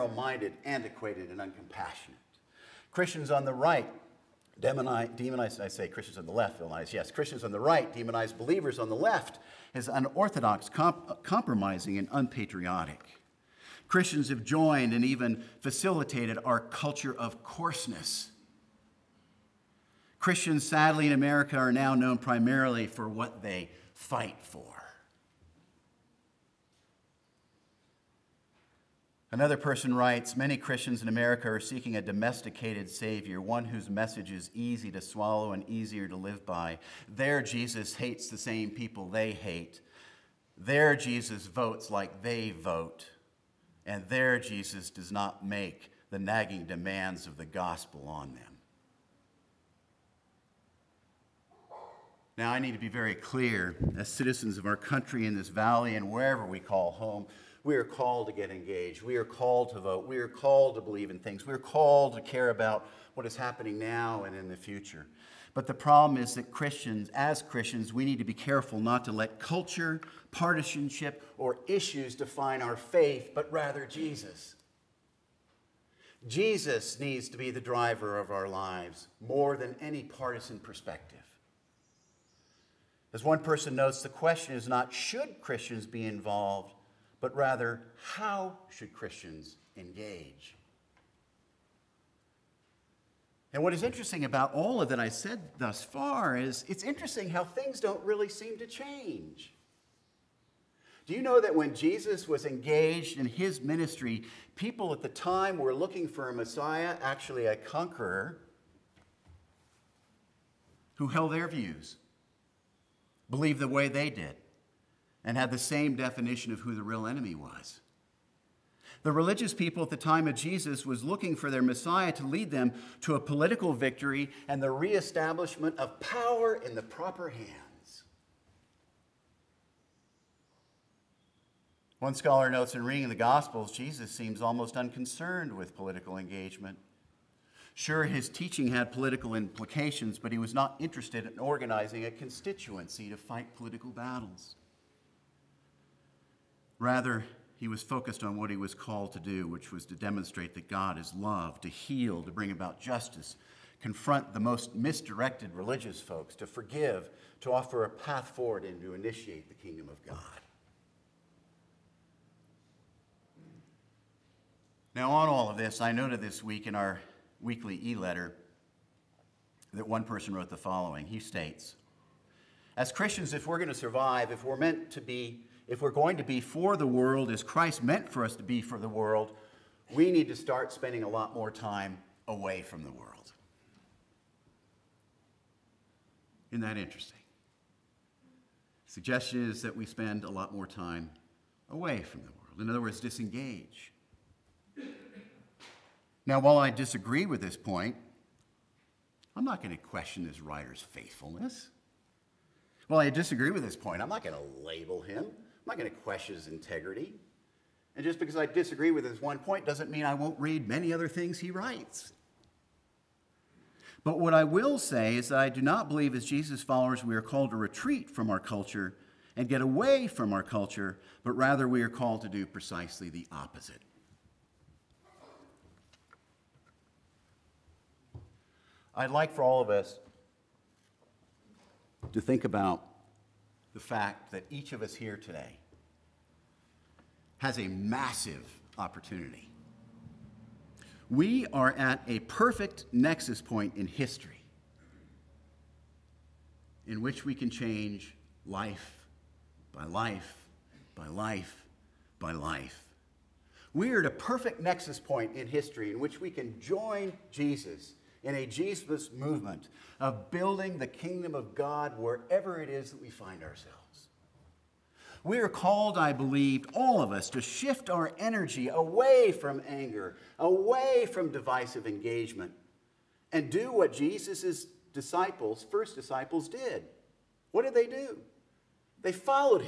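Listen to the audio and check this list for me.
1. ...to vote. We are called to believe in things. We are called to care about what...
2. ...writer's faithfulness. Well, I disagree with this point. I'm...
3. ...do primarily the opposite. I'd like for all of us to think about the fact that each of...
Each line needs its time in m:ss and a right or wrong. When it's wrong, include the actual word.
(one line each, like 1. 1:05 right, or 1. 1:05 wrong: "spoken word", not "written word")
1. 0:59 right
2. 3:20 right
3. 3:42 wrong: "precisely", not "primarily".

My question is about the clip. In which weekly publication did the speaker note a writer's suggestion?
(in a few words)
e letter.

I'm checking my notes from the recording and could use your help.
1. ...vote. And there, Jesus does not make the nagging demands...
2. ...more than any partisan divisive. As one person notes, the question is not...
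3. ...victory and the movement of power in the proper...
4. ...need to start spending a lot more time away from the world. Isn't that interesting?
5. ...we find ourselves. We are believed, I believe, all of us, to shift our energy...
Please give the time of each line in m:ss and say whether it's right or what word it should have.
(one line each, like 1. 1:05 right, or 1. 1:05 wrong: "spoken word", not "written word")
1. 0:42 right
2. 1:19 wrong: "perspective", not "divisive"
3. 2:03 wrong: "reestablishment", not "movement"
4. 3:00 right
5. 4:23 wrong: "called", not "believed".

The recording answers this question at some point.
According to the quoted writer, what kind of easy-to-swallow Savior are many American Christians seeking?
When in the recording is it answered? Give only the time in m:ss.
0:32.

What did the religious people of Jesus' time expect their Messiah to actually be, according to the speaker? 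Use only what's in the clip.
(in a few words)
a conqueror.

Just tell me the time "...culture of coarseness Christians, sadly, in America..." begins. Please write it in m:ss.
0:16.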